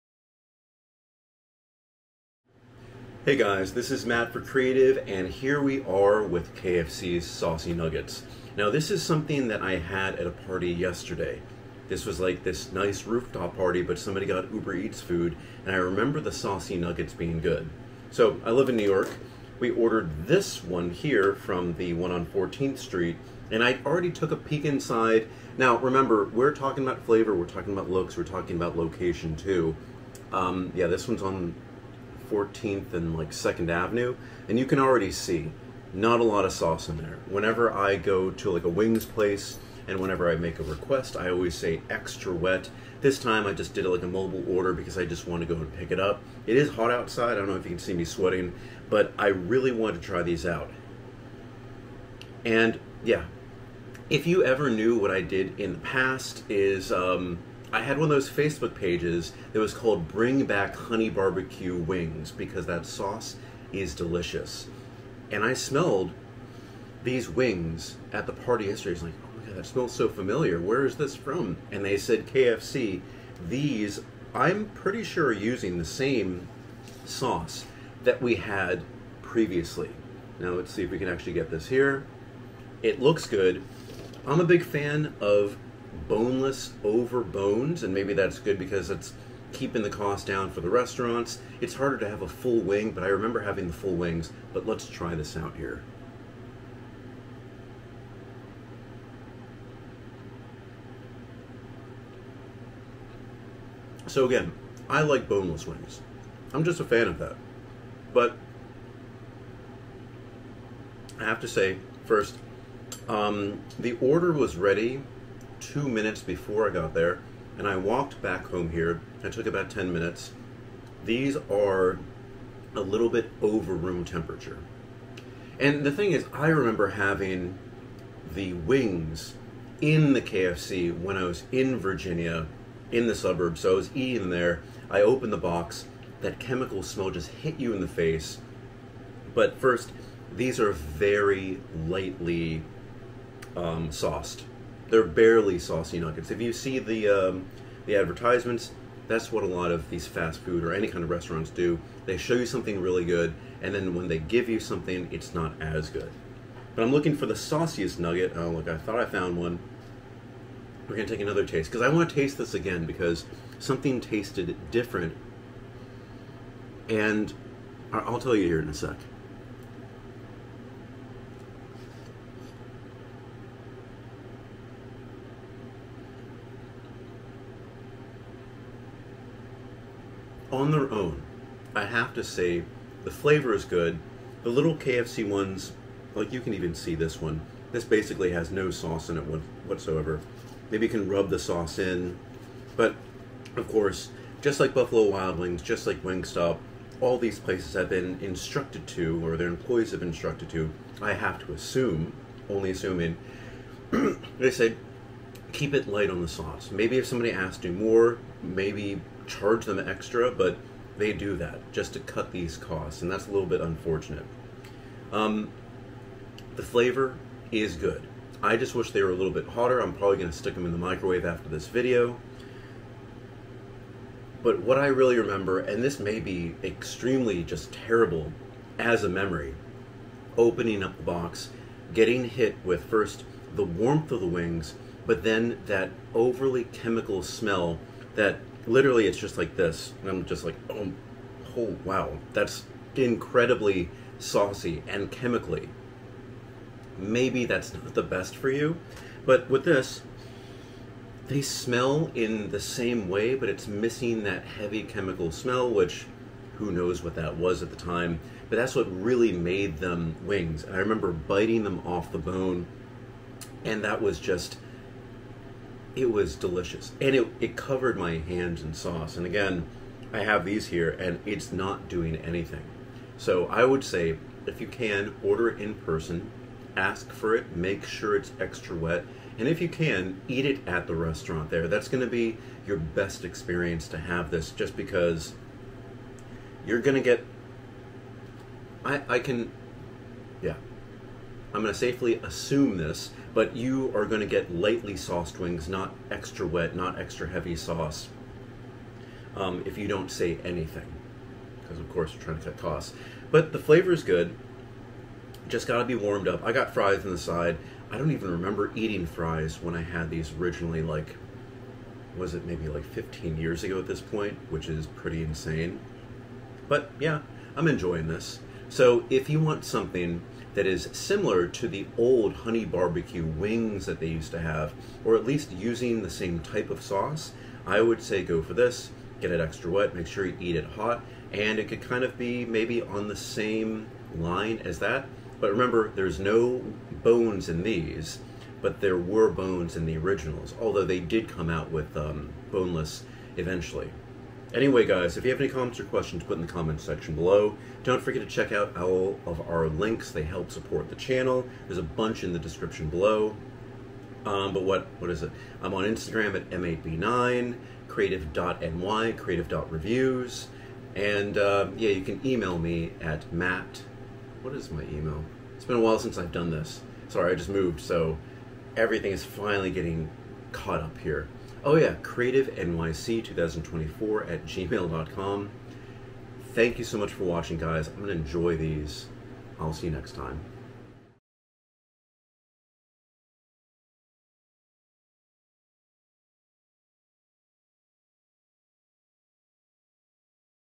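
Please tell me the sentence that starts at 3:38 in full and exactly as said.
I just wish they were a little bit hotter.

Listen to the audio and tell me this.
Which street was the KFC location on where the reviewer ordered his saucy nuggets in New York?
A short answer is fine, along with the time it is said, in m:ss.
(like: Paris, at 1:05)
14th Street, at 0:22.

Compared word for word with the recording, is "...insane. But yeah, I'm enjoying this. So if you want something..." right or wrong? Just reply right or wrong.
right.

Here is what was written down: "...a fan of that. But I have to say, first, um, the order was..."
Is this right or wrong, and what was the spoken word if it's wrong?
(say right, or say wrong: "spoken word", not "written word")
right.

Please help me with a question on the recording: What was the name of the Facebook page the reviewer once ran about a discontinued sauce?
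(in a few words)
Bring Back Honey Barbecue Wings.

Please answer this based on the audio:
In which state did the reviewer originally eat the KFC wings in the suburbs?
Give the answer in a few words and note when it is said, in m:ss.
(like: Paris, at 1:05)
Virginia, at 2:11.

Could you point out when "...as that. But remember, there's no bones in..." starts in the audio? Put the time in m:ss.
5:34.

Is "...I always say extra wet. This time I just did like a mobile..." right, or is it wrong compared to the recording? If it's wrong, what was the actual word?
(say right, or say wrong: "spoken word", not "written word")
right.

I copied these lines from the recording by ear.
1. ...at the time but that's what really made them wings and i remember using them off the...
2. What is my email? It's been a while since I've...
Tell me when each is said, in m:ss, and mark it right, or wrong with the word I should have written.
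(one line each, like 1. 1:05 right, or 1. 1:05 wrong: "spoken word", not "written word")
1. 4:17 wrong: "biting", not "using"
2. 6:04 right.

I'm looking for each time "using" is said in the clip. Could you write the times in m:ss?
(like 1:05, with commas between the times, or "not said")
1:15, 5:25.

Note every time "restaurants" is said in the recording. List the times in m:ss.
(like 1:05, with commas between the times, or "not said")
1:30, 2:31, 4:40.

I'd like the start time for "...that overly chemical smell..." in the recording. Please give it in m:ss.
3:55.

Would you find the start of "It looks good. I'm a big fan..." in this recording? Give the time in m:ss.
1:22.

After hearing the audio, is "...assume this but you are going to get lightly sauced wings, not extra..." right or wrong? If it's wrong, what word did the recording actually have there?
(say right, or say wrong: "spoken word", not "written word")
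right.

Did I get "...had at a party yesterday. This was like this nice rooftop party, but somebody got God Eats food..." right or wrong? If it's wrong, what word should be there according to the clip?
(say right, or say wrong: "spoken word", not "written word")
wrong: "Uber", not "God".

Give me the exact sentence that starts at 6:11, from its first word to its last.
Oh, yeah, NYC 2024 at gmail.com.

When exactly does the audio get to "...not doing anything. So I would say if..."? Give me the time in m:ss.
4:31.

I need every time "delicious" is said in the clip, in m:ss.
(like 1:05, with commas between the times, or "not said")
1:03, 4:26.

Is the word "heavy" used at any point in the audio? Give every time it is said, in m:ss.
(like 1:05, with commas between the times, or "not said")
4:14, 4:57.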